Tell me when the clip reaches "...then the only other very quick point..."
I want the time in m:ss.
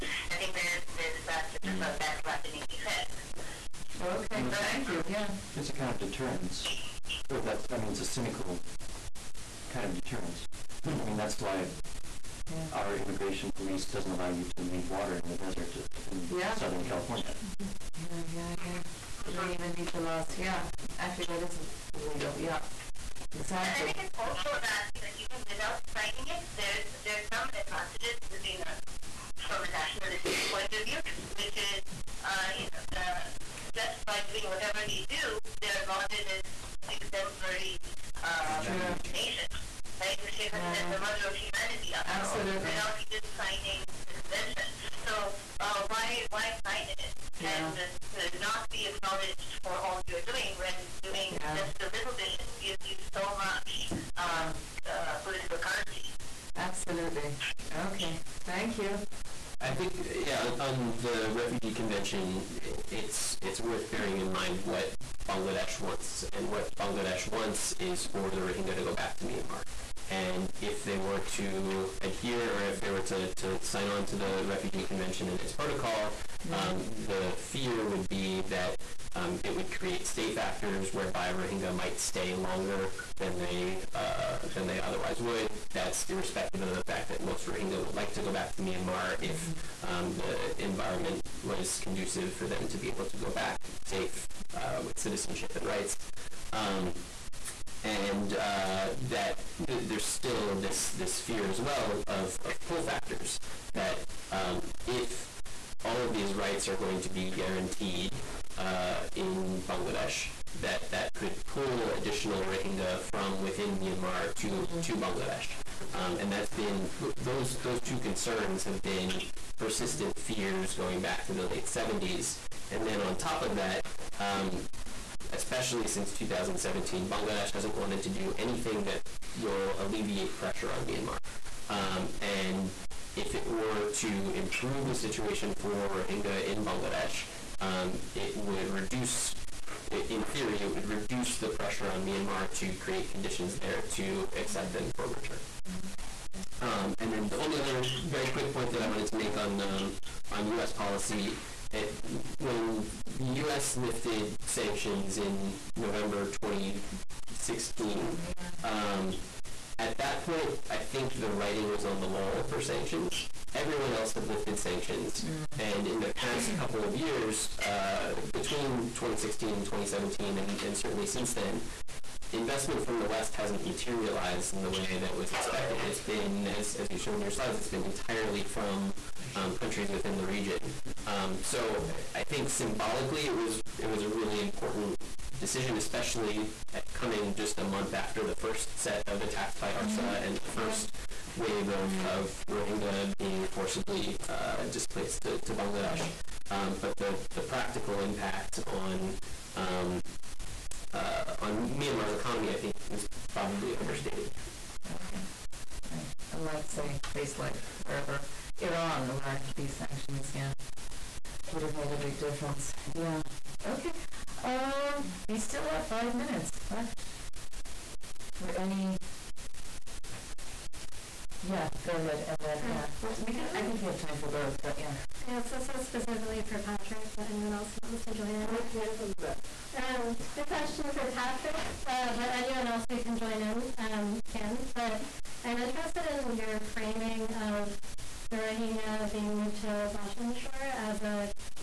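2:27.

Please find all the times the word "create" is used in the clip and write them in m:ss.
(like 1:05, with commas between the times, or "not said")
1:19, 2:22.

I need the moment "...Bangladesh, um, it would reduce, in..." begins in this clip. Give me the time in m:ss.
2:16.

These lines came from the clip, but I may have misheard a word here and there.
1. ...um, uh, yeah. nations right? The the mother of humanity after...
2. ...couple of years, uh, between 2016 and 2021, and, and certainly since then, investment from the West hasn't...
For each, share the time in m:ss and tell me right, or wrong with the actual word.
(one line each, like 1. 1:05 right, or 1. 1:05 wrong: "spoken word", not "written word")
1. 0:38 right
2. 2:46 wrong: "2017", not "2021".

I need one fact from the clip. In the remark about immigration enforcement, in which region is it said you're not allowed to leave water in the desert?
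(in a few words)
Southern California.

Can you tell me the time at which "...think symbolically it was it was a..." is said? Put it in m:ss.
3:02.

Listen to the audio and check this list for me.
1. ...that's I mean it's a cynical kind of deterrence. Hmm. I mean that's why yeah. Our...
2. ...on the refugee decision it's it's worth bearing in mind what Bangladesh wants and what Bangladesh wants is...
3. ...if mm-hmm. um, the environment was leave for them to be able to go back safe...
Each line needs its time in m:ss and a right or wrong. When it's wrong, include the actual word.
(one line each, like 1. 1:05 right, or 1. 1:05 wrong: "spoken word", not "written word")
1. 0:07 right
2. 1:00 wrong: "convention", not "decision"
3. 1:29 wrong: "conducive", not "leave".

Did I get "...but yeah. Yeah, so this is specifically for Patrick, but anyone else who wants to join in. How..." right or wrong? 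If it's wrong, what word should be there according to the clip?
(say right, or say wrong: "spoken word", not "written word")
right.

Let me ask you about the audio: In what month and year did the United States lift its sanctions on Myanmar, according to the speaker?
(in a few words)
November 2016.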